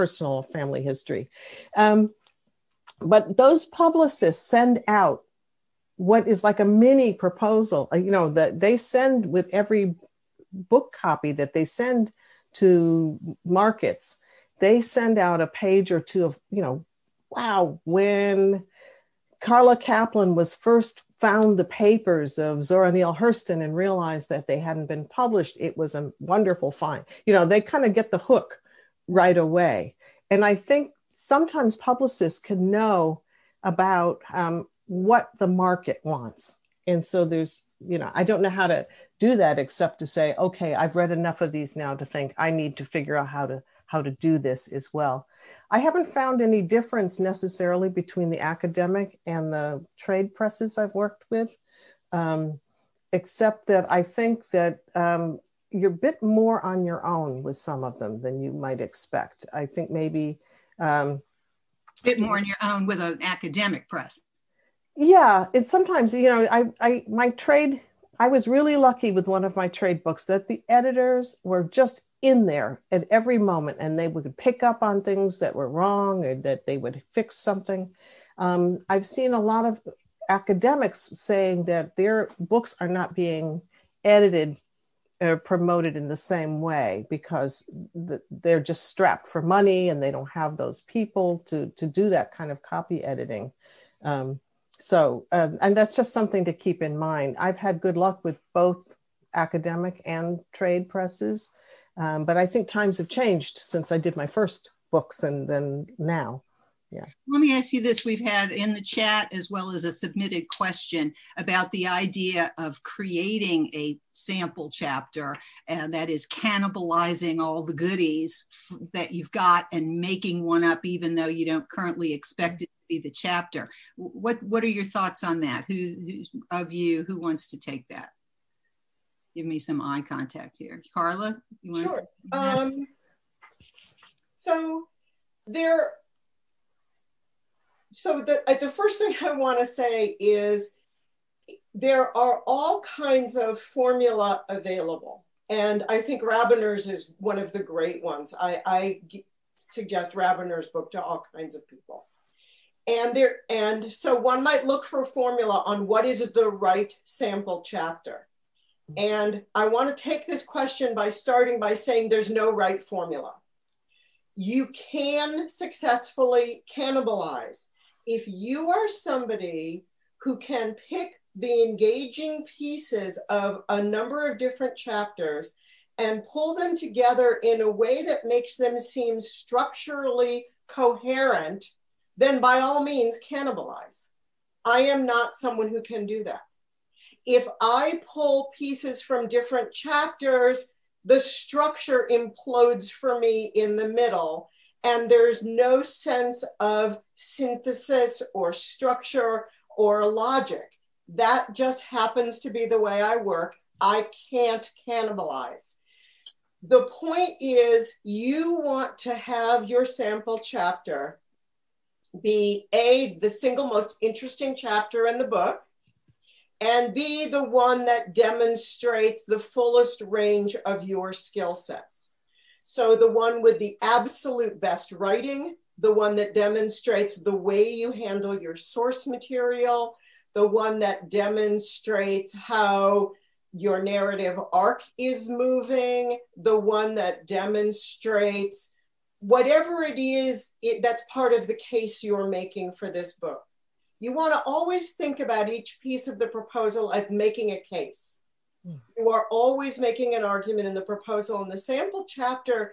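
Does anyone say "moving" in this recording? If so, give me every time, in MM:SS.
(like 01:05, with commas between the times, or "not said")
03:55.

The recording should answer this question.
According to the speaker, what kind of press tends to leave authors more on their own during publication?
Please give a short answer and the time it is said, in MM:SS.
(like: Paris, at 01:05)
Academic press, at 01:03.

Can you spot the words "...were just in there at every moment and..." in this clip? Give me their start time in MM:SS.
01:11.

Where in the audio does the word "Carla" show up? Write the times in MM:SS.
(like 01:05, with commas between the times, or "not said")
00:19, 02:10.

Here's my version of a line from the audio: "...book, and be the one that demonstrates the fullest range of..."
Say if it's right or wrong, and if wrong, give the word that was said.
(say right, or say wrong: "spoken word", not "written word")
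right.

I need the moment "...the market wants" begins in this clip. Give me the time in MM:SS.
00:35.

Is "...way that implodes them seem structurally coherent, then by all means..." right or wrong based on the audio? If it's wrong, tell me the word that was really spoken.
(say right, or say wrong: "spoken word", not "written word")
wrong: "makes", not "implodes".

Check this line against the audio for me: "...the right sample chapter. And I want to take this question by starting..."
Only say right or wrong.
right.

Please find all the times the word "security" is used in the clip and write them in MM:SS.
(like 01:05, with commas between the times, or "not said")
not said.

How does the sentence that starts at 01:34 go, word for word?
Um, so, um, and that's just something to keep in mind.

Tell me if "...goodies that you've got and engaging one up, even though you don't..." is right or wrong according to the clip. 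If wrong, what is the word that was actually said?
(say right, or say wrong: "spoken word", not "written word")
wrong: "making", not "engaging".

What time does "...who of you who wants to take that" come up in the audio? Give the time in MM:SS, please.
02:05.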